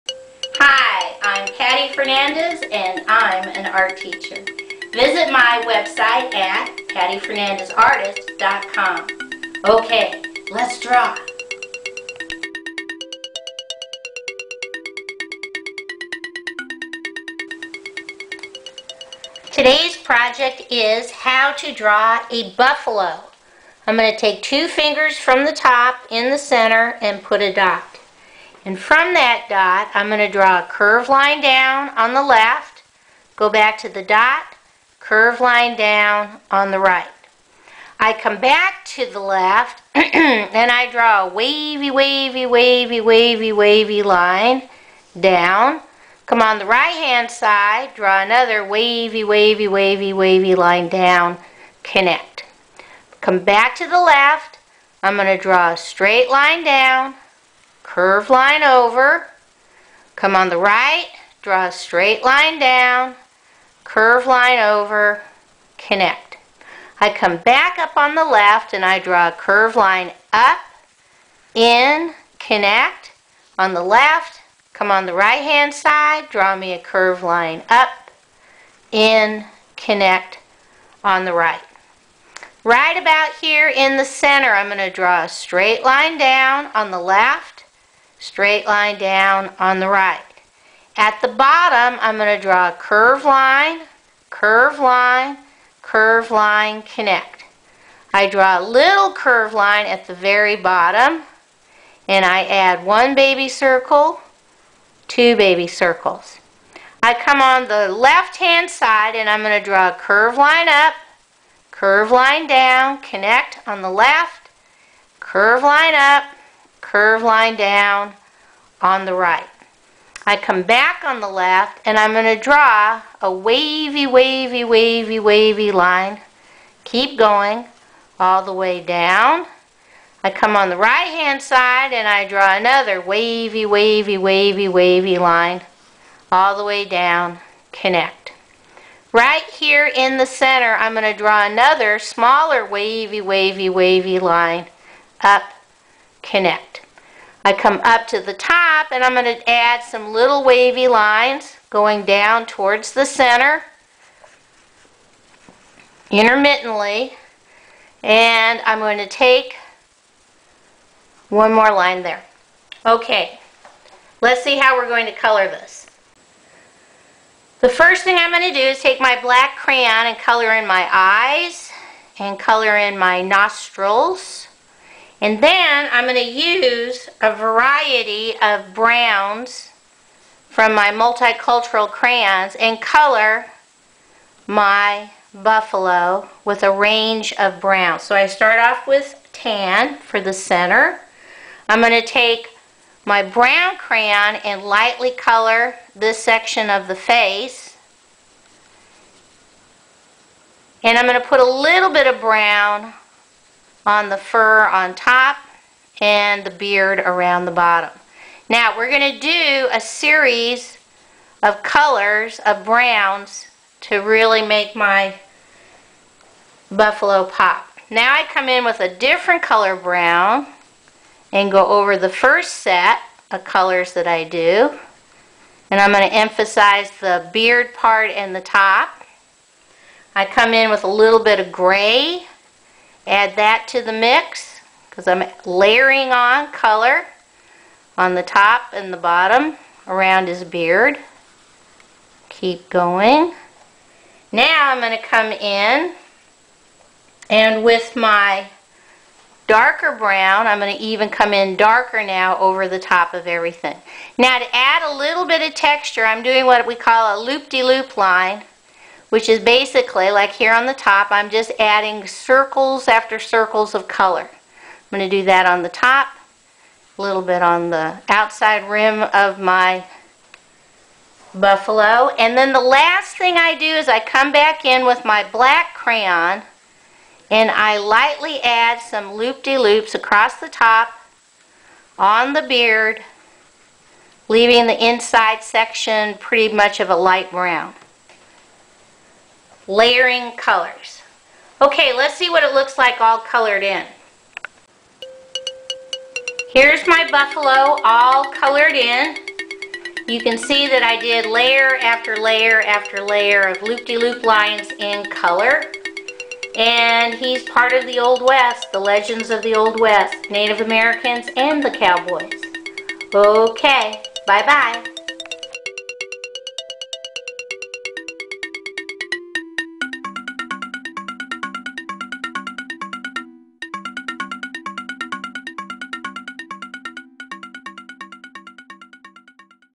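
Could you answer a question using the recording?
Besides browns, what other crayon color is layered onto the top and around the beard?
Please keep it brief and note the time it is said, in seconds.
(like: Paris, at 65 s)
Gray, at 231 s.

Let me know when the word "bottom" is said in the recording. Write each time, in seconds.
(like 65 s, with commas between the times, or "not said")
91 s, 100 s, 207 s, 238 s.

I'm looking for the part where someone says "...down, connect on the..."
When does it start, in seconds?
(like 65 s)
112 s.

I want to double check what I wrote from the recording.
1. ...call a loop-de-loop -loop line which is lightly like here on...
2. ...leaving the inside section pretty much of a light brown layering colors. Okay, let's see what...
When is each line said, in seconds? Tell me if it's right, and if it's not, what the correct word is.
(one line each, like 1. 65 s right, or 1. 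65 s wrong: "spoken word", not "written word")
1. 256 s wrong: "basically", not "lightly"
2. 284 s right.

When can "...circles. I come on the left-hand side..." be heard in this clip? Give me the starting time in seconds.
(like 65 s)
105 s.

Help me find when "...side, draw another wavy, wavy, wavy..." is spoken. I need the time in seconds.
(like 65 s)
47 s.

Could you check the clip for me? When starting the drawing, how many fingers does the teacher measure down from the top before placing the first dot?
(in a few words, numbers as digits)
2.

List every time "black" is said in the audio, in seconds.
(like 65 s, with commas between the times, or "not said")
169 s, 275 s.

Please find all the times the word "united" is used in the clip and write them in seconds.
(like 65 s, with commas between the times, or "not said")
not said.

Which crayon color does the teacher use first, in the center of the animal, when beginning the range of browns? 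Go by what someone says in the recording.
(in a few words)
Tan.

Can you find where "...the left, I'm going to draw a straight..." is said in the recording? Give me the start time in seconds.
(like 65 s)
53 s.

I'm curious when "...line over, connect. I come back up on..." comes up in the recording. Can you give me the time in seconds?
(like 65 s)
64 s.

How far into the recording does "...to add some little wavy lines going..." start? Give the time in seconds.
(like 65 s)
149 s.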